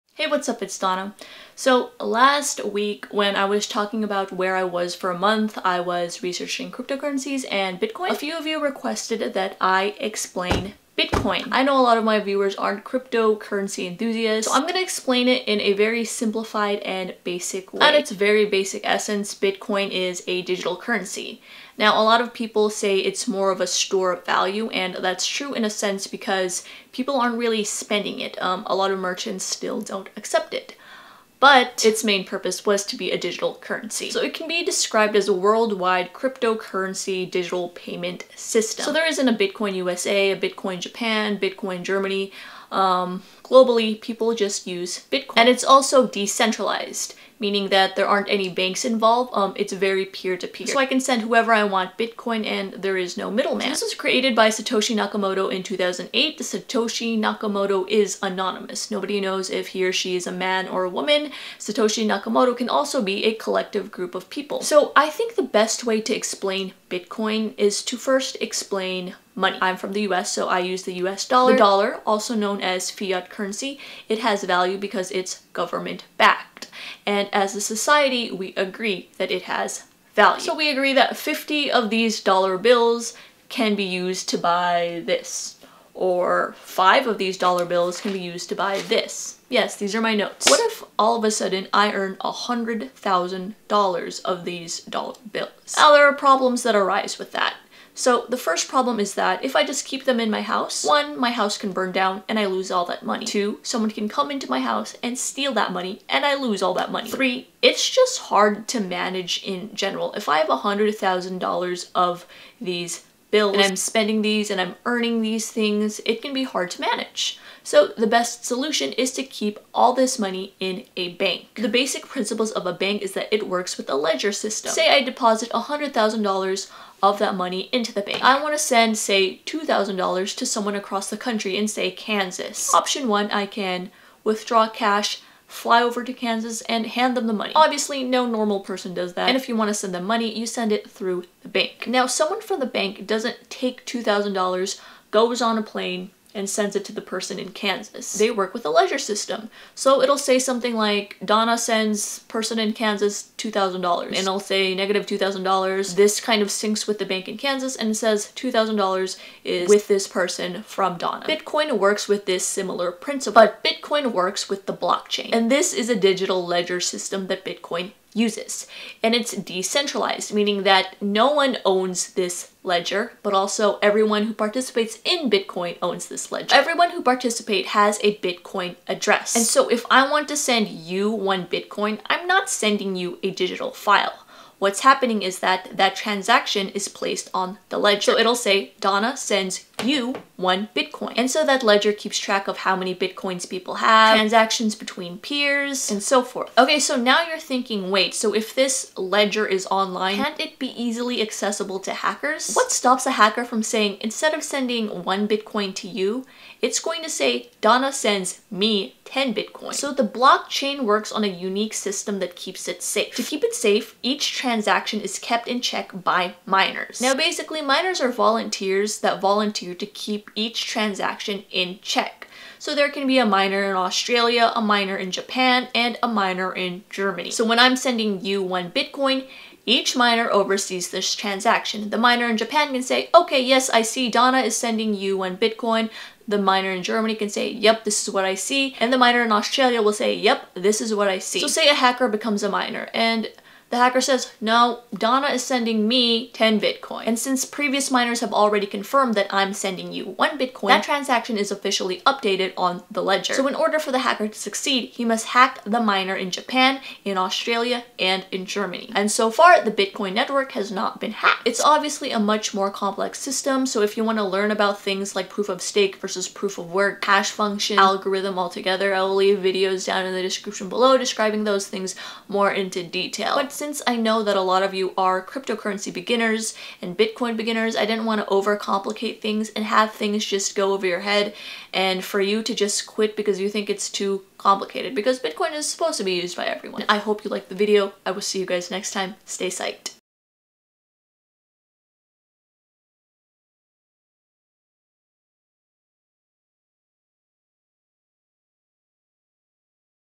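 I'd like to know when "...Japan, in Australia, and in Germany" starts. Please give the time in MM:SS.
04:16.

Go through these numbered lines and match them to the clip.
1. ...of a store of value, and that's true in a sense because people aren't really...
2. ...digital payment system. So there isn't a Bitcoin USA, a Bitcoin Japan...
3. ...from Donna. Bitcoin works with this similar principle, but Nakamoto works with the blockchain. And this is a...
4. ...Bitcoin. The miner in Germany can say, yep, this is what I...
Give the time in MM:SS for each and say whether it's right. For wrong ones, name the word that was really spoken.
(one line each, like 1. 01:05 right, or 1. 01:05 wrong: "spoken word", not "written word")
1. 00:23 right
2. 00:37 right
3. 02:40 wrong: "Bitcoin", not "Nakamoto"
4. 03:55 right.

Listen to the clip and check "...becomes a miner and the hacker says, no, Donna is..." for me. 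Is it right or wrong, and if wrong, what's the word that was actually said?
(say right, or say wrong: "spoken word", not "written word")
right.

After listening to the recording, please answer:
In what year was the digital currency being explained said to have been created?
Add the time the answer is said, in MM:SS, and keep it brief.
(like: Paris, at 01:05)
2008, at 00:55.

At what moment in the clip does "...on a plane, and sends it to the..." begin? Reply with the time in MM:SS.
02:25.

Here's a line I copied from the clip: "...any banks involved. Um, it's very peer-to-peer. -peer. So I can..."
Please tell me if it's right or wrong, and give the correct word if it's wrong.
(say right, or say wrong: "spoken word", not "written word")
right.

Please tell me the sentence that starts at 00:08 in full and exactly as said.
A few of you requested that I explain Bitcoin.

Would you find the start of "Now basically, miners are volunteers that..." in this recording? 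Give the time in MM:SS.
03:37.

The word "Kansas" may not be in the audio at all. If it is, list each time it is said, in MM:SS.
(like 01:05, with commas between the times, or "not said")
02:11, 02:16, 02:27, 02:32, 02:37.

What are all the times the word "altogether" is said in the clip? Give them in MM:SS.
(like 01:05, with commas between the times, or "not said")
04:28.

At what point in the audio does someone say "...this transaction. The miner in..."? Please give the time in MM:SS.
03:50.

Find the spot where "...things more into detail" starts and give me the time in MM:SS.
04:31.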